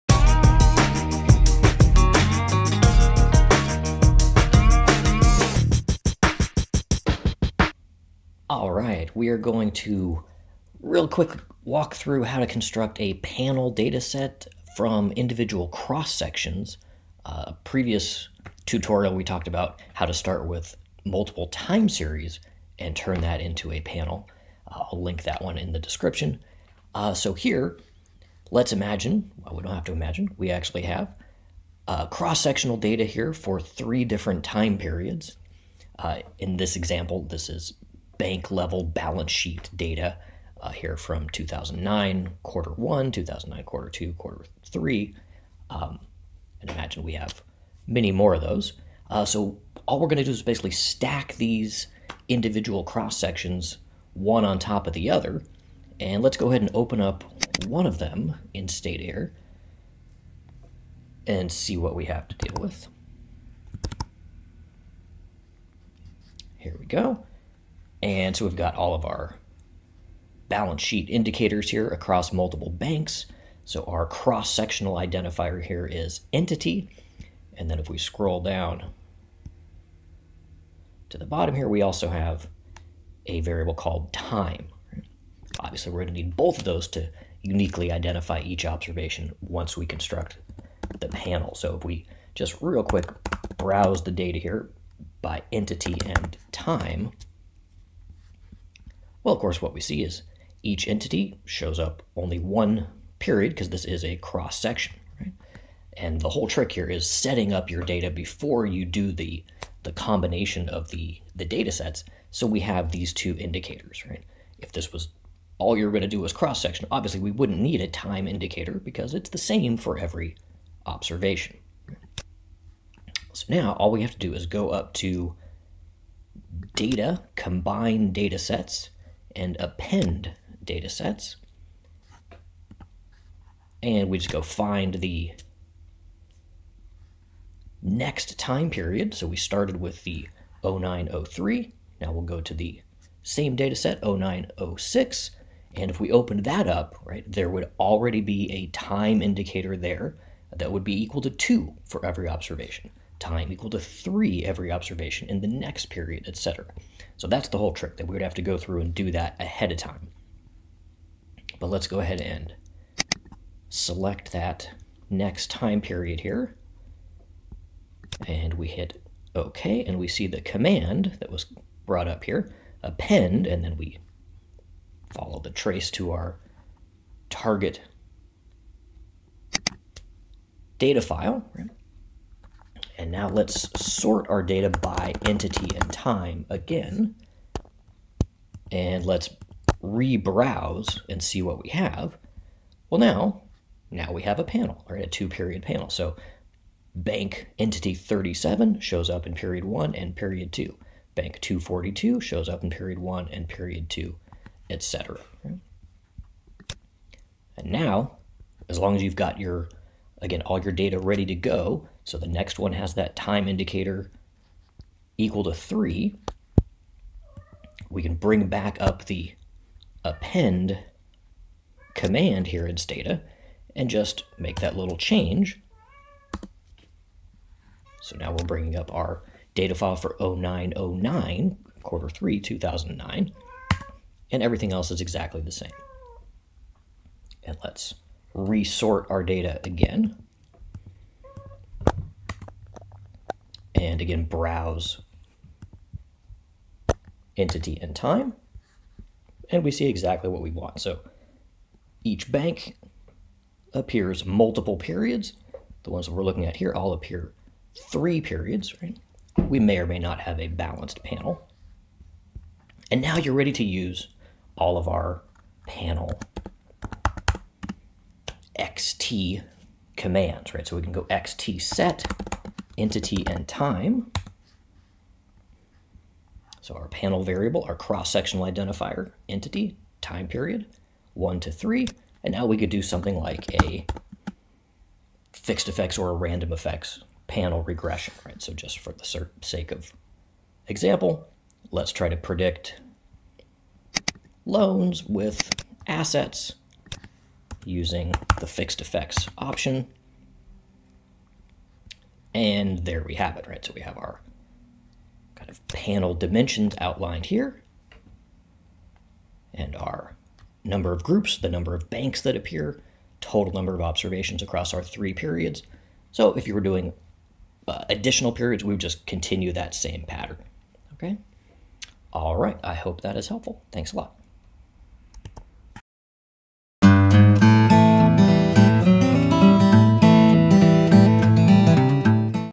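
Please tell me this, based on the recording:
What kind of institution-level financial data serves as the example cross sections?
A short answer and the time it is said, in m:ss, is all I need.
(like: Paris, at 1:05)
Bank level balance sheet data, at 0:38.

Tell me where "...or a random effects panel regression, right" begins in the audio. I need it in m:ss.
4:45.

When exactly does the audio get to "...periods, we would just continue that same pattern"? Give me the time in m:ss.
5:18.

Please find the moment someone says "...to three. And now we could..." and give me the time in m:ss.
4:41.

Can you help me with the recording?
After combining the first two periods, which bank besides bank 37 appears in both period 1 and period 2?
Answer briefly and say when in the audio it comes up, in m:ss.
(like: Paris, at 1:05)
242, at 3:21.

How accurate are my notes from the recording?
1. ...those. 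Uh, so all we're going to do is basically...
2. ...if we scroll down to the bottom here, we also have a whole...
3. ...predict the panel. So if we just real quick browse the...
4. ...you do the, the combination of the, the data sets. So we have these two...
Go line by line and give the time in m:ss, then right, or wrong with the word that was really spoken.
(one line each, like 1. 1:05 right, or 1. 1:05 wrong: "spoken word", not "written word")
1. 0:48 right
2. 1:17 wrong: "variable", not "whole"
3. 1:29 wrong: "construct", not "predict"
4. 1:48 right.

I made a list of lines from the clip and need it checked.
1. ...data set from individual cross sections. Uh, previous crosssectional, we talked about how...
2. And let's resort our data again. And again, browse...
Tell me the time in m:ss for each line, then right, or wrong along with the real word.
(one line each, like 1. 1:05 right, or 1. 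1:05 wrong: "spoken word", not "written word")
1. 0:13 wrong: "tutorial", not "crosssectional"
2. 3:57 right.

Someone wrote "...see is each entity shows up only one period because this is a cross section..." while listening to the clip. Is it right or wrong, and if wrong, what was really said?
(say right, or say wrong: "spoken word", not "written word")
right.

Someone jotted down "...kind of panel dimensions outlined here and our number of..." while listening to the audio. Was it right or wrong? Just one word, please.
right.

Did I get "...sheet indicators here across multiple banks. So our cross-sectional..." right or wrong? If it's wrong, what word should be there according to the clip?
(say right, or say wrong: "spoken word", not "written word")
right.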